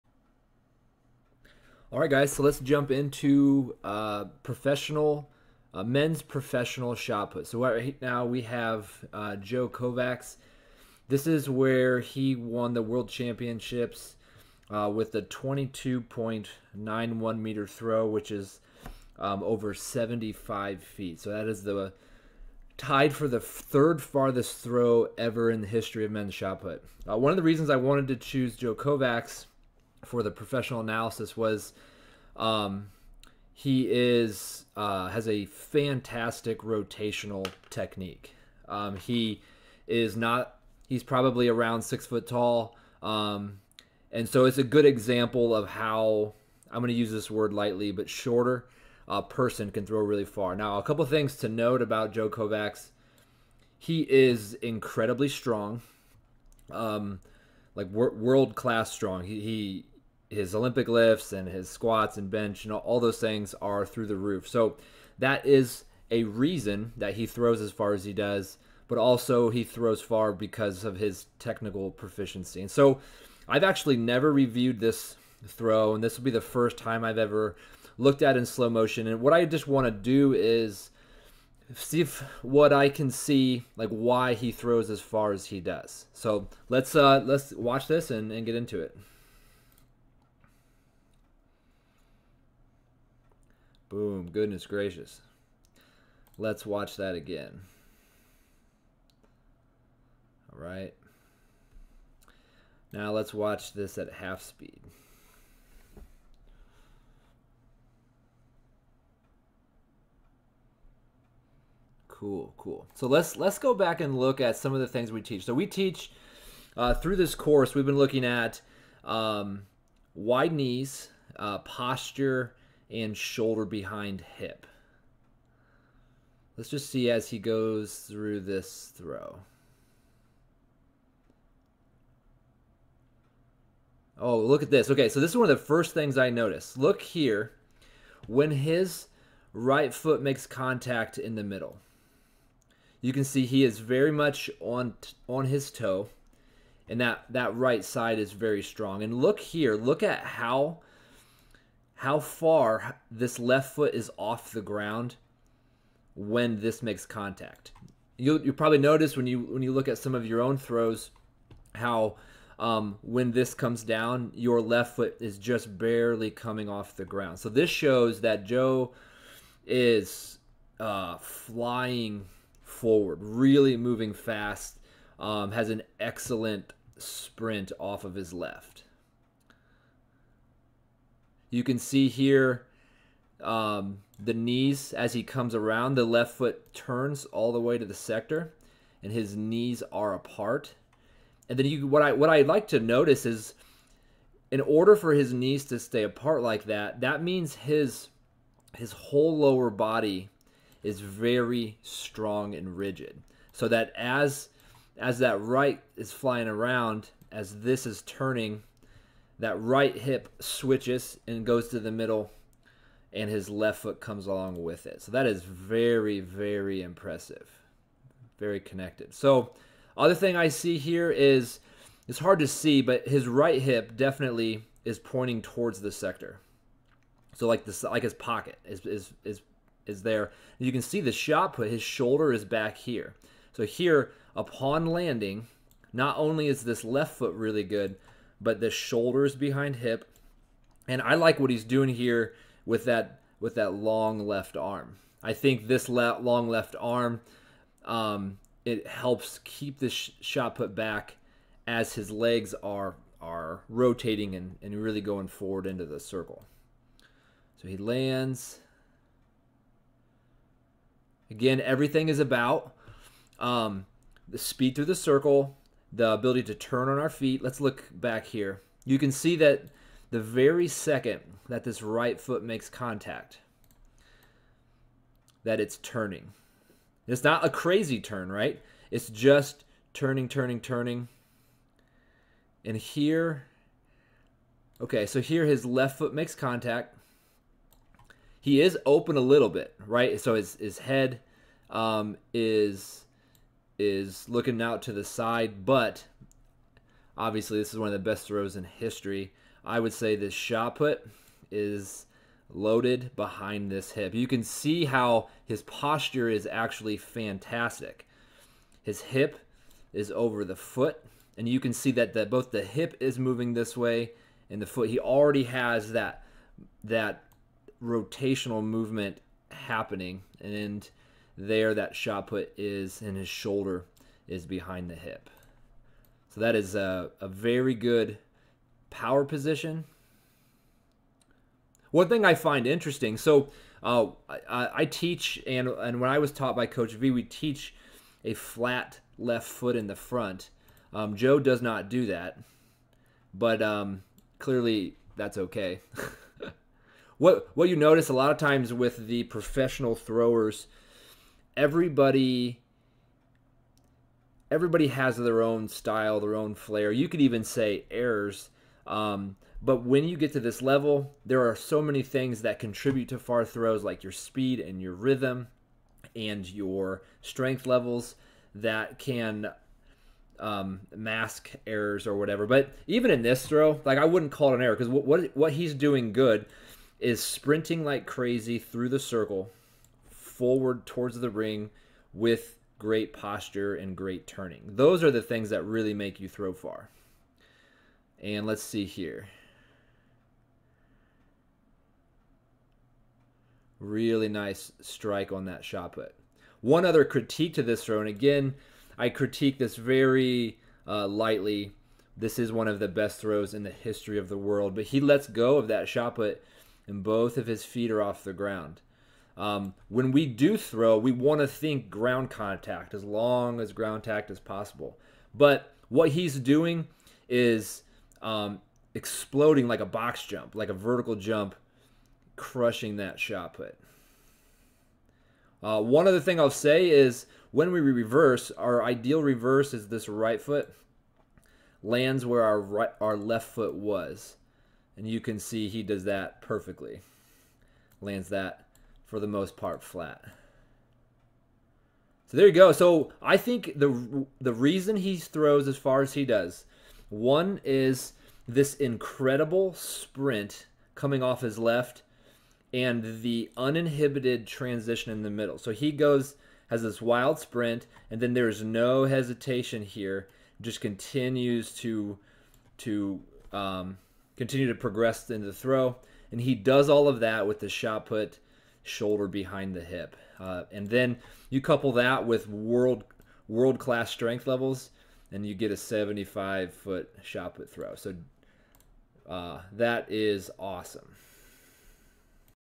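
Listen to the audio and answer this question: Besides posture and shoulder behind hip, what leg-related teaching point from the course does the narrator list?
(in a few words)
wide knees.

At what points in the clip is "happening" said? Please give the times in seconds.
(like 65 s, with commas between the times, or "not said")
319 s.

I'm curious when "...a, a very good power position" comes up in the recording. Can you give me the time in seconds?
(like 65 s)
326 s.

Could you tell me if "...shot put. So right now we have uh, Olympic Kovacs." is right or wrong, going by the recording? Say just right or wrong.
wrong.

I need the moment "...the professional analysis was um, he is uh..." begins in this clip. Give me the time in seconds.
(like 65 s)
30 s.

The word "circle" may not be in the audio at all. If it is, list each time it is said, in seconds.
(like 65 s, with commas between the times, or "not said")
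255 s, 264 s, 378 s.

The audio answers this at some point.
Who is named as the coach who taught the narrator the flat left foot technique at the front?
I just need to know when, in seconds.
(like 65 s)
336 s.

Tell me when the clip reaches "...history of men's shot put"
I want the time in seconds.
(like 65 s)
25 s.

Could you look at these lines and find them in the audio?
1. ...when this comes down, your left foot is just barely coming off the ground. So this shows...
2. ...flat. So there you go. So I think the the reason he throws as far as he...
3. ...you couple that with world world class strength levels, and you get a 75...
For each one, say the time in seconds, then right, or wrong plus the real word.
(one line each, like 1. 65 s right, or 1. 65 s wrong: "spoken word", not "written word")
1. 163 s right
2. 439 s right
3. 471 s right.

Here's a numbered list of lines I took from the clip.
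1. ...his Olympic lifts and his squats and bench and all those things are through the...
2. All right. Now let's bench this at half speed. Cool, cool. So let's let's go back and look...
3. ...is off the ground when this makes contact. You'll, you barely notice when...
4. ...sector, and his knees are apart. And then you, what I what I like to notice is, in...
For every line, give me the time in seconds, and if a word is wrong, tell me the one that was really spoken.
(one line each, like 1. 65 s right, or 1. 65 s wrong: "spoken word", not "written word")
1. 60 s right
2. 100 s wrong: "watch", not "bench"
3. 153 s wrong: "probably", not "barely"
4. 187 s right.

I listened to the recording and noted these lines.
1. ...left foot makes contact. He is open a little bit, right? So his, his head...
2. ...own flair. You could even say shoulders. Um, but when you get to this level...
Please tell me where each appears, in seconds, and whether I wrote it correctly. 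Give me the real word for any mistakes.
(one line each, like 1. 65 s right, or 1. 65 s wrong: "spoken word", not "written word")
1. 285 s right
2. 356 s wrong: "errors", not "shoulders".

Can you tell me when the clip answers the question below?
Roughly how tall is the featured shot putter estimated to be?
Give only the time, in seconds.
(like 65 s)
41 s.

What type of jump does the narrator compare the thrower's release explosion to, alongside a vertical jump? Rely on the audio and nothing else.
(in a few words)
box jump.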